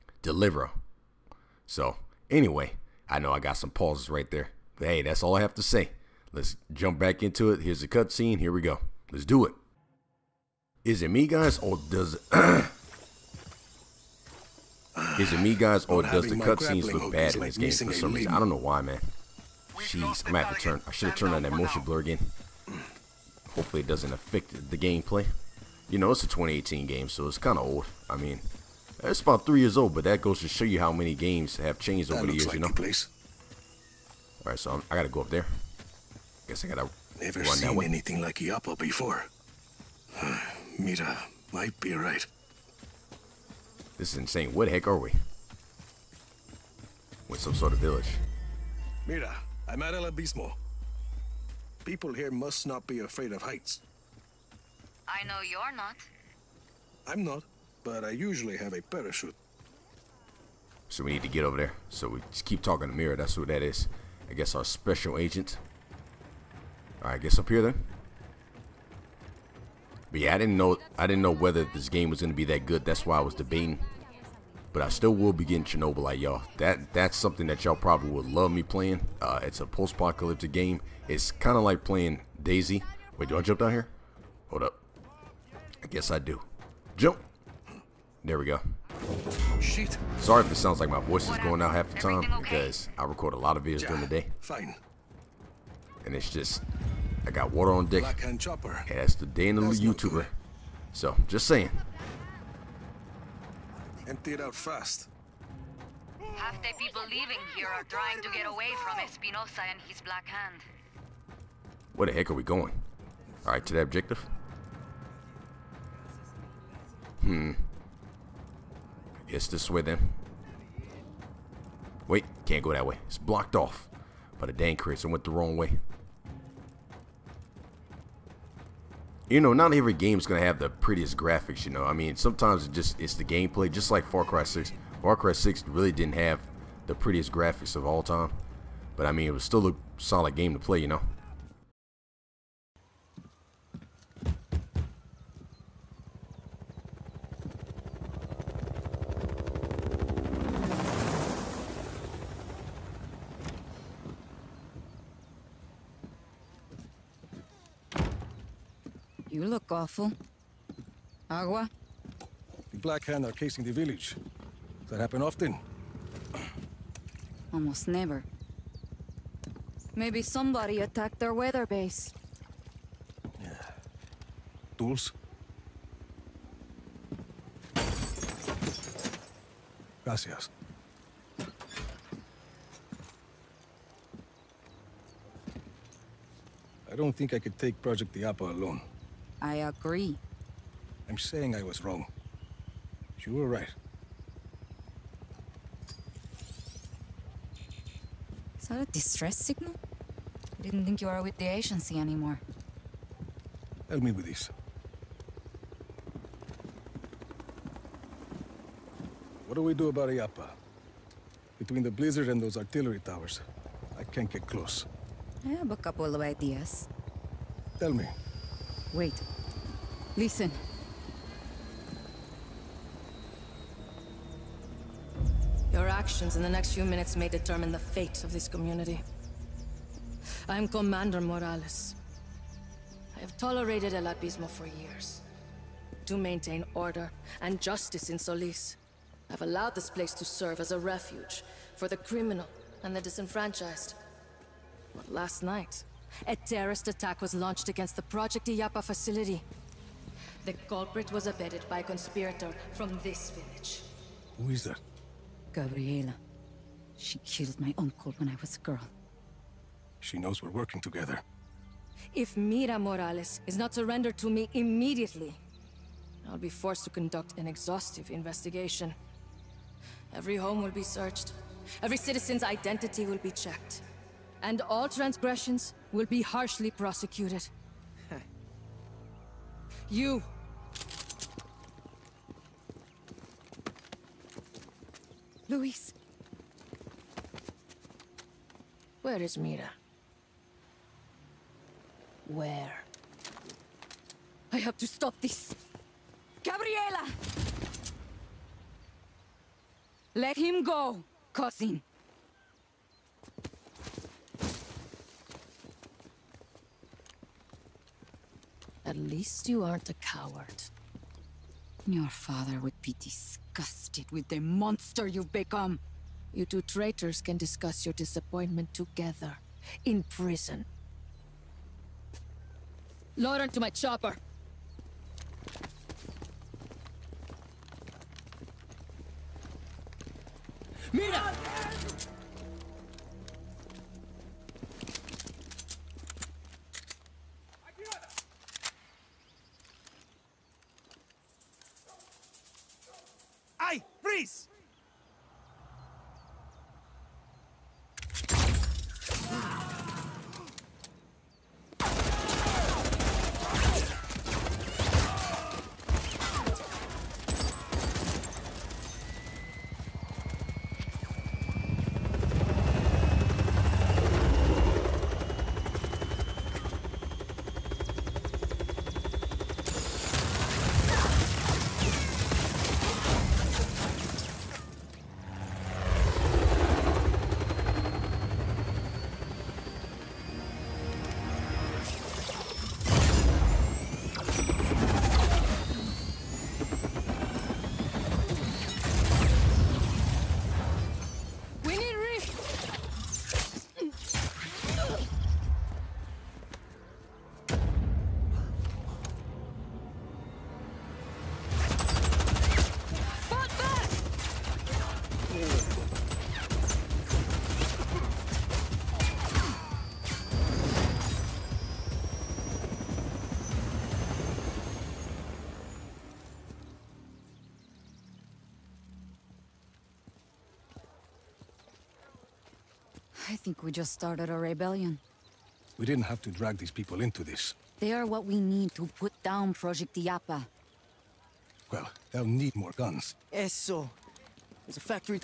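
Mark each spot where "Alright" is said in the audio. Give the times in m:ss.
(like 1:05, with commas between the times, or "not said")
1:07, 1:53.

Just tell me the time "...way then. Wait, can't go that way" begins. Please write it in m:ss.
1:59.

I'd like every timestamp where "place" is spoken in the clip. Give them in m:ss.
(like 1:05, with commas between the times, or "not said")
0:32, 3:59.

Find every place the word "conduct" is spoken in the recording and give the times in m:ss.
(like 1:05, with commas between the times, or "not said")
4:26.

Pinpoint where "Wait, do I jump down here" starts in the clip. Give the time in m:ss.
1:23.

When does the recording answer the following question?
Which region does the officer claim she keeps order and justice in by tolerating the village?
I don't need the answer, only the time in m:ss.
3:58.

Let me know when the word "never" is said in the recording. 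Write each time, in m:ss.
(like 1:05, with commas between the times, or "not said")
0:37, 2:47.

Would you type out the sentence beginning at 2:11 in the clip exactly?
You know, I mean, sometimes it just it's the gameplay.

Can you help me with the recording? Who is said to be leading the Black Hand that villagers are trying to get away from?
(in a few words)
Espinosa.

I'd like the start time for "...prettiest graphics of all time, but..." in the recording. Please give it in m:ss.
2:16.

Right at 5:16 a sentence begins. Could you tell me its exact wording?
You two traitors can discuss your disappointment together.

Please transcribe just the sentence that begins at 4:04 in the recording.
But last night, a terrorist attack was launched against the Project Illapa facility.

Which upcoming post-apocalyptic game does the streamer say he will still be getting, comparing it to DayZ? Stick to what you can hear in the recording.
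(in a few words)
Chernobylite.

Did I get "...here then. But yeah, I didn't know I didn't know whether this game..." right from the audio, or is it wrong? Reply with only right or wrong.
right.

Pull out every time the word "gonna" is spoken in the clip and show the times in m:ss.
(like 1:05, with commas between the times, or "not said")
1:12, 2:10.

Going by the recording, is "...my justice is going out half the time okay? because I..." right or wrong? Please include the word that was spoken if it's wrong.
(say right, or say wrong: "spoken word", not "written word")
wrong: "voice", not "justice".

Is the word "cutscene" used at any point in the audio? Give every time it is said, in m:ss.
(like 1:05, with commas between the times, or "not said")
0:07, 0:16.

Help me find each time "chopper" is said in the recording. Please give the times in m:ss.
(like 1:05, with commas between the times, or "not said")
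1:38, 5:23.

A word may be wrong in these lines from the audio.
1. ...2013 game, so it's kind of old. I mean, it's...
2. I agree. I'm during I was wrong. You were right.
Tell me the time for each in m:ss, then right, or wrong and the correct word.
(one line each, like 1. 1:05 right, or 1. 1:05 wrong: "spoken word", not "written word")
1. 0:26 wrong: "2018", not "2013"
2. 3:09 wrong: "saying", not "during".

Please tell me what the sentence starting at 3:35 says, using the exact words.
I have a couple of ideas.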